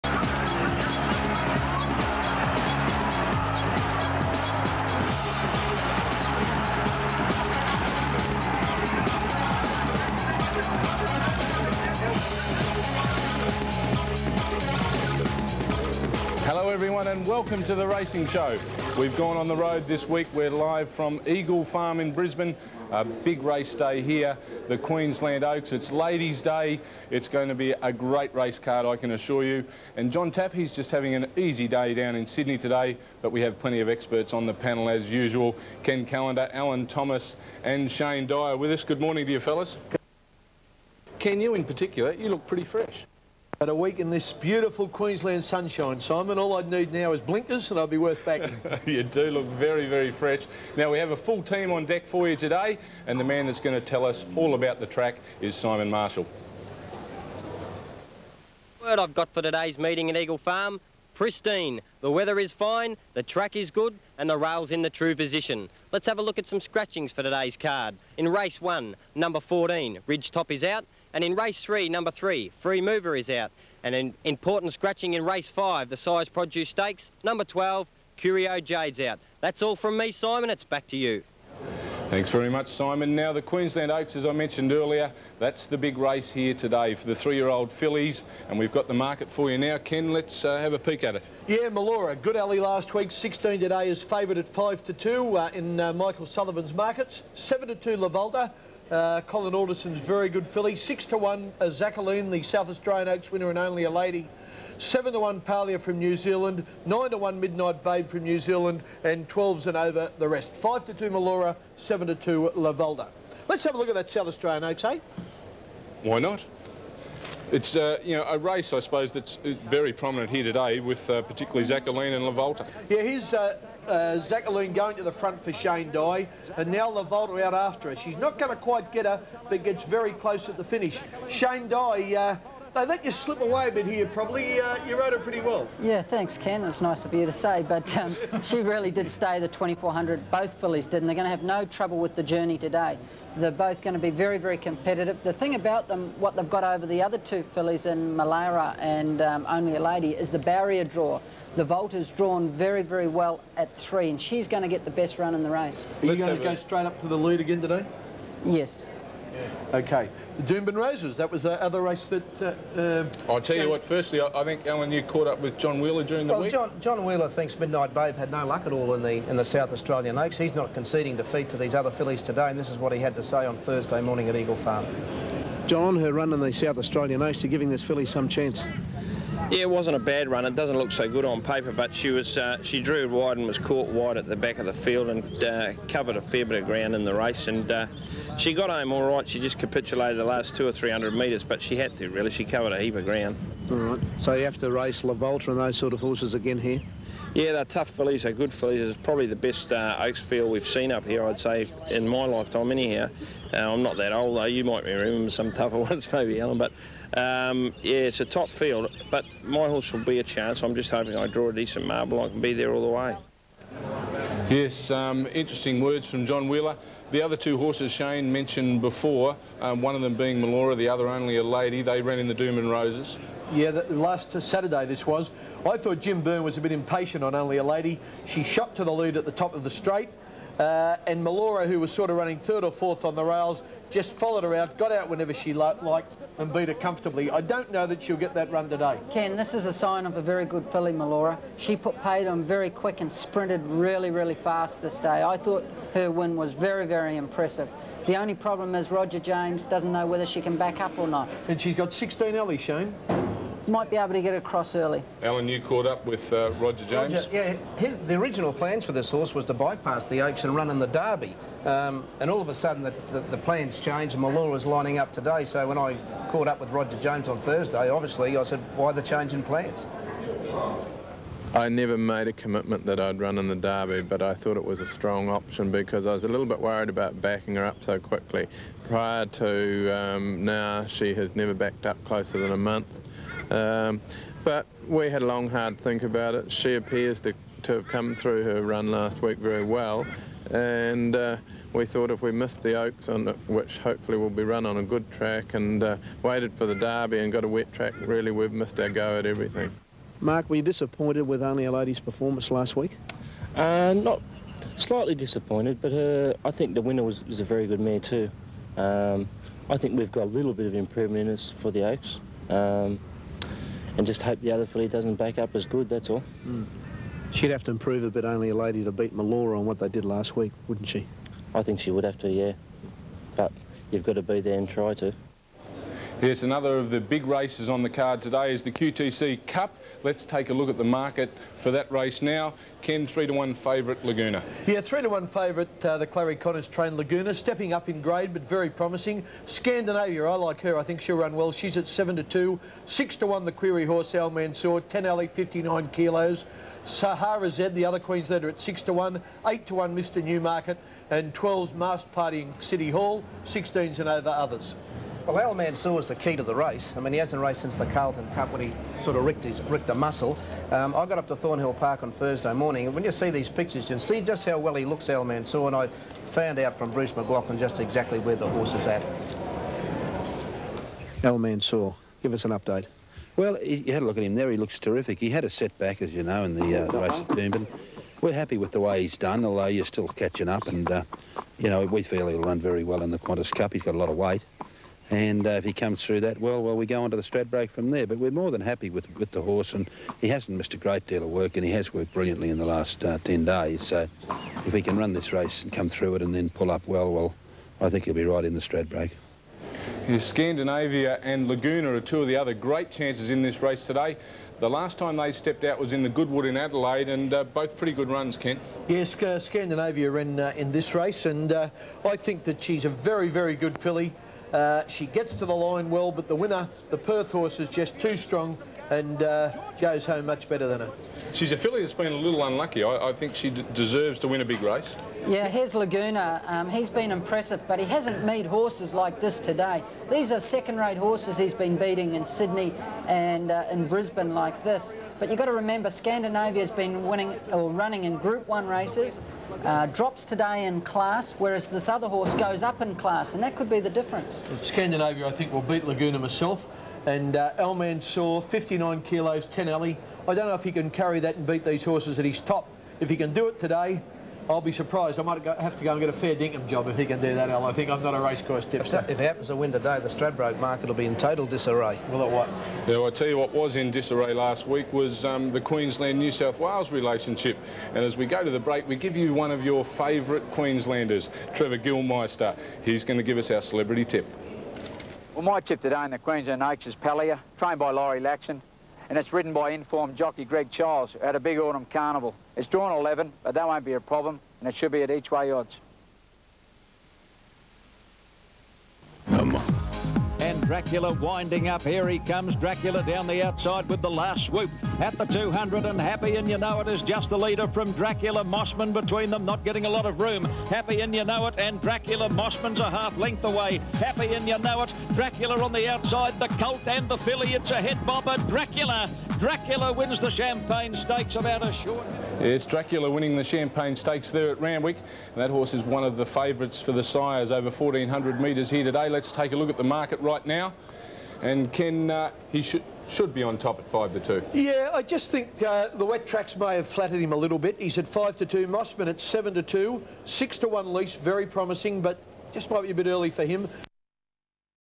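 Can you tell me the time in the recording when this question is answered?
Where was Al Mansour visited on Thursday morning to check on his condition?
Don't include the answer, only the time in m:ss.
6:01.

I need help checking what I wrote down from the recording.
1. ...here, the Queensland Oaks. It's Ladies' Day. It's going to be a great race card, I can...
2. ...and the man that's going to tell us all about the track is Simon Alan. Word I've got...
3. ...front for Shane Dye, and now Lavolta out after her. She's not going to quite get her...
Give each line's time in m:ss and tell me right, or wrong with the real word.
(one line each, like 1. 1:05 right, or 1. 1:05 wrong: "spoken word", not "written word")
1. 0:24 right
2. 0:53 wrong: "Marshall", not "Alan"
3. 2:05 right.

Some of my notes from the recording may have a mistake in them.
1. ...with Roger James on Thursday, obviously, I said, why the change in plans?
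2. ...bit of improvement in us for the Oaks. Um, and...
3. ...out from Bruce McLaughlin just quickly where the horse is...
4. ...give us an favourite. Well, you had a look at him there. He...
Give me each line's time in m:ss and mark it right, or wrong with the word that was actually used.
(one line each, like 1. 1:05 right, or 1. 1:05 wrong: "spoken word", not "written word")
1. 4:26 right
2. 5:10 right
3. 6:06 wrong: "exactly", not "quickly"
4. 6:12 wrong: "update", not "favourite".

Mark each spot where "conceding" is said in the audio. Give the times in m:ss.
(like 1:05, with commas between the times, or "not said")
2:50.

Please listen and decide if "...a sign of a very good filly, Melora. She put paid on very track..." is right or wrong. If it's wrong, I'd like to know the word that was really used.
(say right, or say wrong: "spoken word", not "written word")
wrong: "quick", not "track".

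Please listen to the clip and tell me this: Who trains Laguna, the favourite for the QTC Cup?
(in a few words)
Clarry Conners.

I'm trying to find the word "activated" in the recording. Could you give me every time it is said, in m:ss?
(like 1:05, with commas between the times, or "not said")
not said.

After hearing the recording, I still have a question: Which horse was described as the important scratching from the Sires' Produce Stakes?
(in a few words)
Curio Jade.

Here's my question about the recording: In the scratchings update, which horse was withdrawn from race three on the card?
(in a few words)
Free Mover.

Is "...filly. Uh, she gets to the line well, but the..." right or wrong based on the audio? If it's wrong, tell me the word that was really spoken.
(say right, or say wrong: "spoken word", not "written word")
right.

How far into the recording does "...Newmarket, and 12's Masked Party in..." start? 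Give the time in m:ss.
5:50.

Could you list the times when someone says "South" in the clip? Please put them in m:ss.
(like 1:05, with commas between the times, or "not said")
1:42, 1:54, 2:49, 2:56, 7:46.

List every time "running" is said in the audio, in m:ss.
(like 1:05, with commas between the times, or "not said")
3:52, 7:17.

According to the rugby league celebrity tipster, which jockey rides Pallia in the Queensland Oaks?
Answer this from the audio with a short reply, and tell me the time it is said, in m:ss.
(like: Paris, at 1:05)
Greg Childs, at 8:00.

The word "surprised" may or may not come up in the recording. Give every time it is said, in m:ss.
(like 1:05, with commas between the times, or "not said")
7:34.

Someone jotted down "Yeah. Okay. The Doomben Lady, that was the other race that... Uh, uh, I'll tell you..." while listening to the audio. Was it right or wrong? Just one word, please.
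wrong.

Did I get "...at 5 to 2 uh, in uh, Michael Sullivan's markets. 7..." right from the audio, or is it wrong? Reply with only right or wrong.
right.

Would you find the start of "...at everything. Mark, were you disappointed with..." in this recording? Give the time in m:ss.
4:59.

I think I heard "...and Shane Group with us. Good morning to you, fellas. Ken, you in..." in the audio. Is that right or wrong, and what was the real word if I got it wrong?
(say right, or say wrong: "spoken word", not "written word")
wrong: "Dye", not "Group".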